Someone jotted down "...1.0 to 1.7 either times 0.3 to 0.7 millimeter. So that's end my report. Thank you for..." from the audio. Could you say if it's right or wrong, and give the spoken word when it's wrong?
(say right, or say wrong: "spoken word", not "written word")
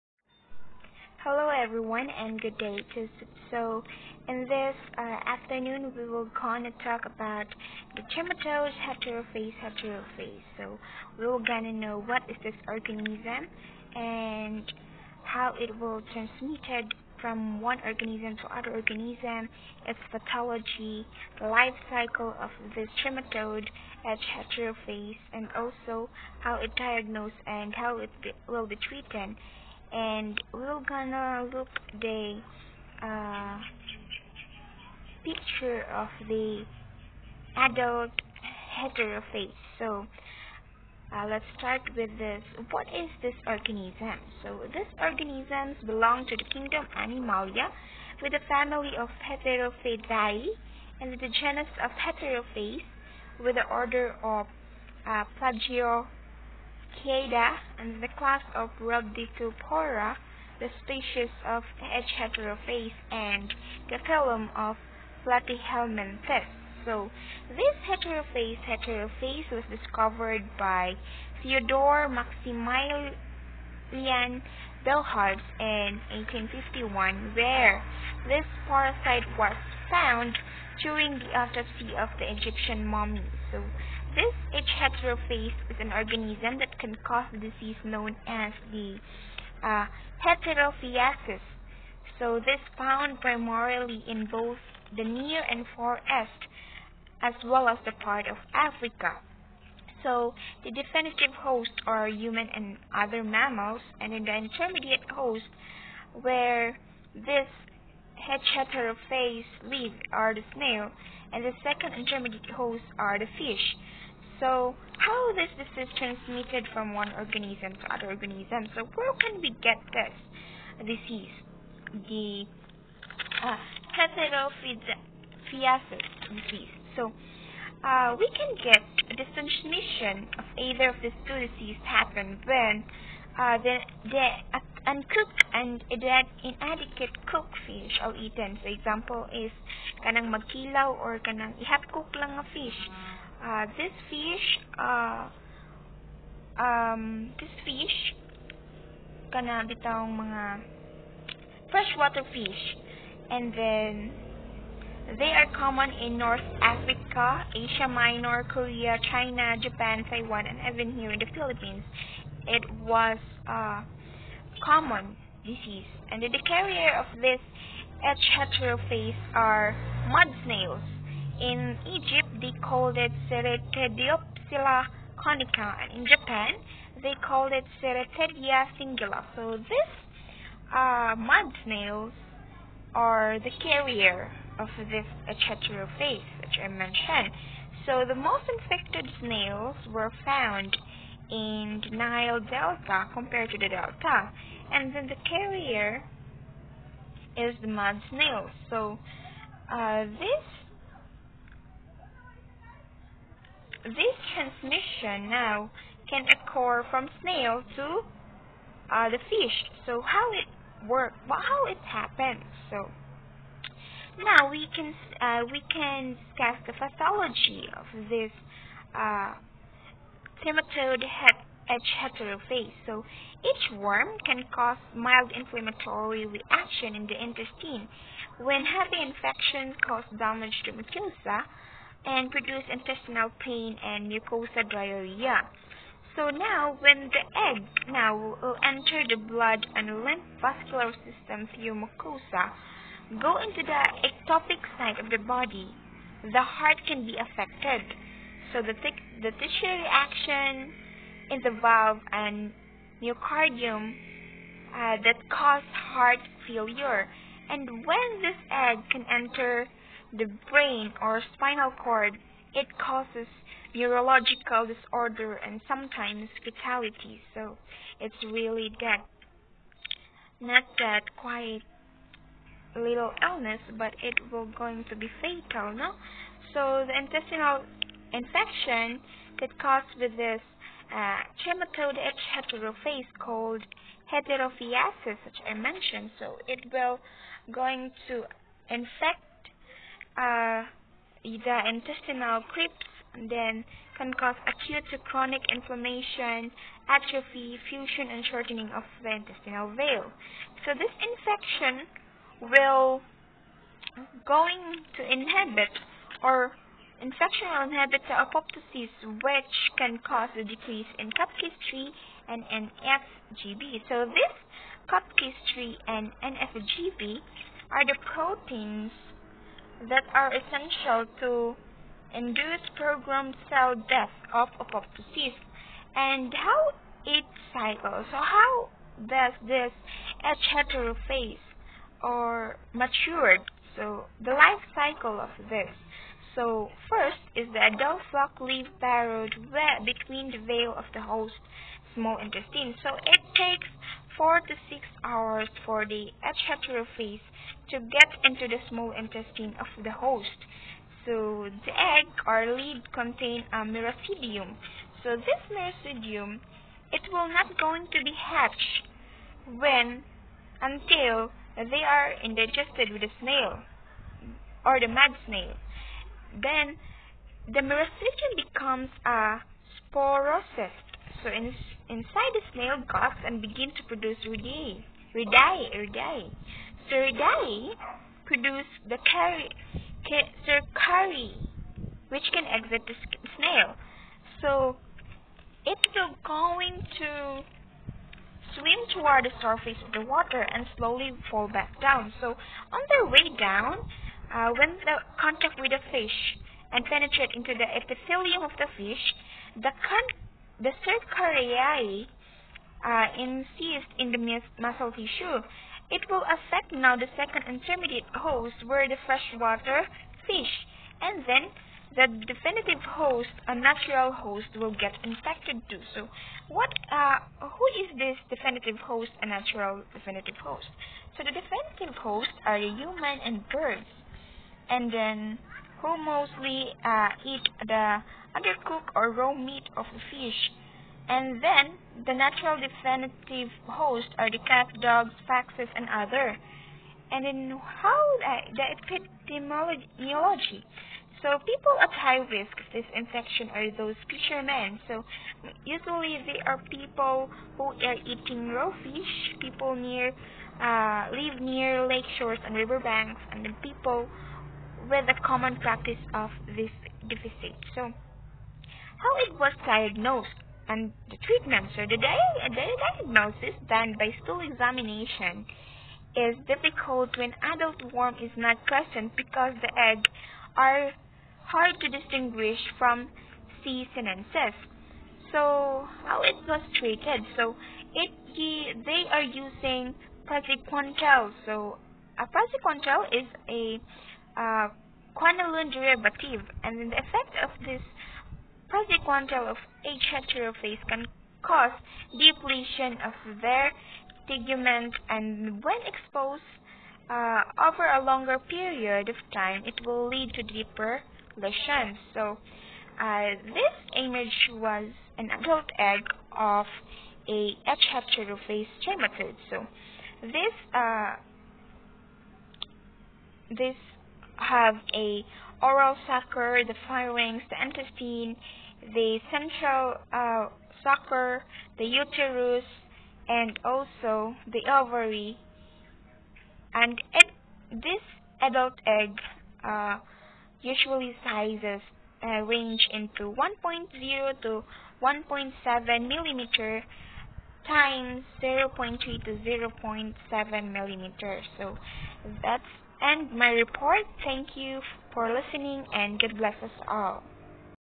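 wrong: "millimeter", not "either".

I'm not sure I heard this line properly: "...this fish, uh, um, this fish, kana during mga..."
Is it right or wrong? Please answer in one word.
wrong.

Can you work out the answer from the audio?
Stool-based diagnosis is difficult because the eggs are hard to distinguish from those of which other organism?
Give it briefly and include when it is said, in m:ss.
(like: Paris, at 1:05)
C. sinensis, at 7:53.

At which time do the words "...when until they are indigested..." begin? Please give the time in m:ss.
5:59.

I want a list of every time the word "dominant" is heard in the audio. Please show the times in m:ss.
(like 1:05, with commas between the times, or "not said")
not said.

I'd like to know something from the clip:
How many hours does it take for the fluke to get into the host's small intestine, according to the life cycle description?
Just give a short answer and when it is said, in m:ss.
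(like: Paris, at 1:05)
4 to 6 hours, at 5:44.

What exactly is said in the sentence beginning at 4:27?
So it's really that not that quite little illness, but it will going to be fatal, no?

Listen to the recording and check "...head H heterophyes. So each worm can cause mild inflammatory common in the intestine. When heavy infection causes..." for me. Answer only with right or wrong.
wrong.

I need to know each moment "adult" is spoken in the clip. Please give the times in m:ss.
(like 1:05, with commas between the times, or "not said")
0:37, 5:37, 7:47, 8:25, 8:48.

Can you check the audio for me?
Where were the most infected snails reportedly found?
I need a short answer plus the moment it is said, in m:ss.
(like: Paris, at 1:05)
Nile Delta, at 3:11.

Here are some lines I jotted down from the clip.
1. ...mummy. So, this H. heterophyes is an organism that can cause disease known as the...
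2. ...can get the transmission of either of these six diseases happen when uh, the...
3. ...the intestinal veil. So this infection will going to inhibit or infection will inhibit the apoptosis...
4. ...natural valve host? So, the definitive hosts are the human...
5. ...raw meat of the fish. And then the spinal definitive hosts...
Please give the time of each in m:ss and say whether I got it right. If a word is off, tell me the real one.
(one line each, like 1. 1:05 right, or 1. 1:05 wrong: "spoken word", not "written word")
1. 1:22 right
2. 2:08 wrong: "two", not "six"
3. 4:59 right
4. 6:59 wrong: "definitive", not "valve"
5. 7:09 wrong: "natural", not "spinal".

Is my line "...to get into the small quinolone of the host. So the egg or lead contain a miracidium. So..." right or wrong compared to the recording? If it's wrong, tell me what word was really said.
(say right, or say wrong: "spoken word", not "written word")
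wrong: "intestine", not "quinolone".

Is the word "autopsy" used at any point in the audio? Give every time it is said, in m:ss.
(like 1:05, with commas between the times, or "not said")
1:21.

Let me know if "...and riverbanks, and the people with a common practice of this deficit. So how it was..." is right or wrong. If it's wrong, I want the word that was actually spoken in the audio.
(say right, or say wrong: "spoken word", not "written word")
right.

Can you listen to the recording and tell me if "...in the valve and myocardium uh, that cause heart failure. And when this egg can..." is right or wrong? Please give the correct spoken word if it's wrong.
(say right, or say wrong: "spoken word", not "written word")
right.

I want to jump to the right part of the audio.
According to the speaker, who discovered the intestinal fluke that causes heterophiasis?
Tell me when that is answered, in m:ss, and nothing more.
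1:11.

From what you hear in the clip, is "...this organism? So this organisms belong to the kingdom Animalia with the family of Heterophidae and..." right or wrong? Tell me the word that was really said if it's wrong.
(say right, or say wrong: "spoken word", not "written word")
right.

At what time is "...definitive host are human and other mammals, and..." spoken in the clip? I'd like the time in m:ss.
1:40.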